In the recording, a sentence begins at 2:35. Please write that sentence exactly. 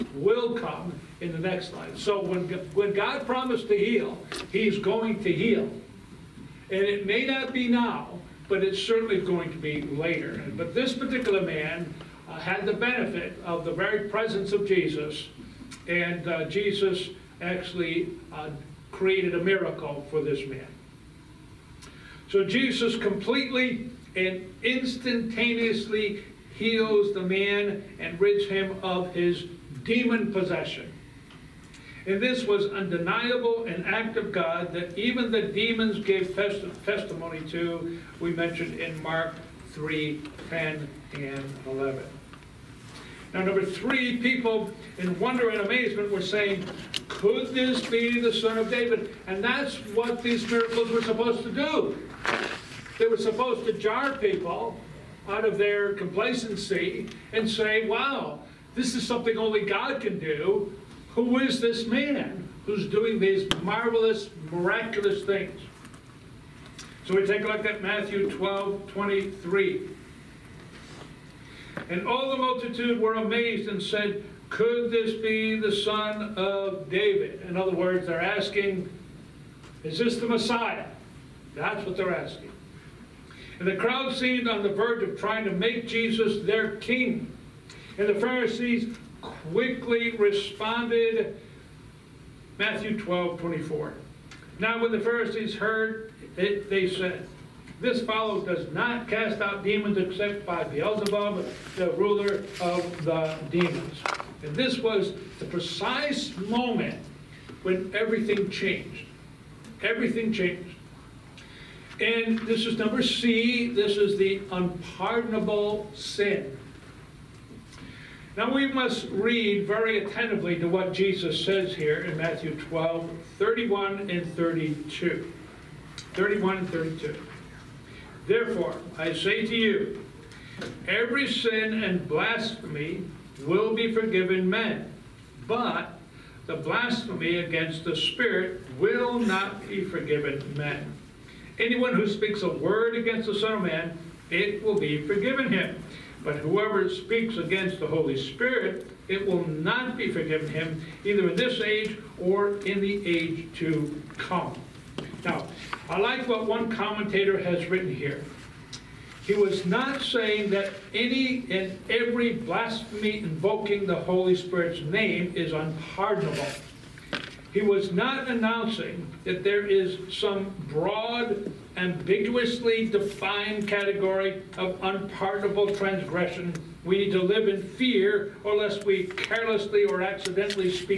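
Now, I like what one commentator has written here.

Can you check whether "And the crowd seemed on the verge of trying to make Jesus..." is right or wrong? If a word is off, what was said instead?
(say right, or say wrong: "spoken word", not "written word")
right.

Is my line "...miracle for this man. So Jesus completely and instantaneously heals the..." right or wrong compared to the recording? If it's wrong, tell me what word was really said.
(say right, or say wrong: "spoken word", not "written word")
right.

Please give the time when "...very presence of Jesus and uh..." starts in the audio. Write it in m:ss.
0:13.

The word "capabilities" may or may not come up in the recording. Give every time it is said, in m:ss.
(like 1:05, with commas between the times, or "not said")
not said.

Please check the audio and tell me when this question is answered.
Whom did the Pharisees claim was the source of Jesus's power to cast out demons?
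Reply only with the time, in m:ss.
1:40.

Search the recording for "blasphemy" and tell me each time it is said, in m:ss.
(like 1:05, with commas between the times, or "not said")
2:12, 2:16, 2:42.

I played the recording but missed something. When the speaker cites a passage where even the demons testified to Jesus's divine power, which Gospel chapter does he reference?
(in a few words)
Mark 3.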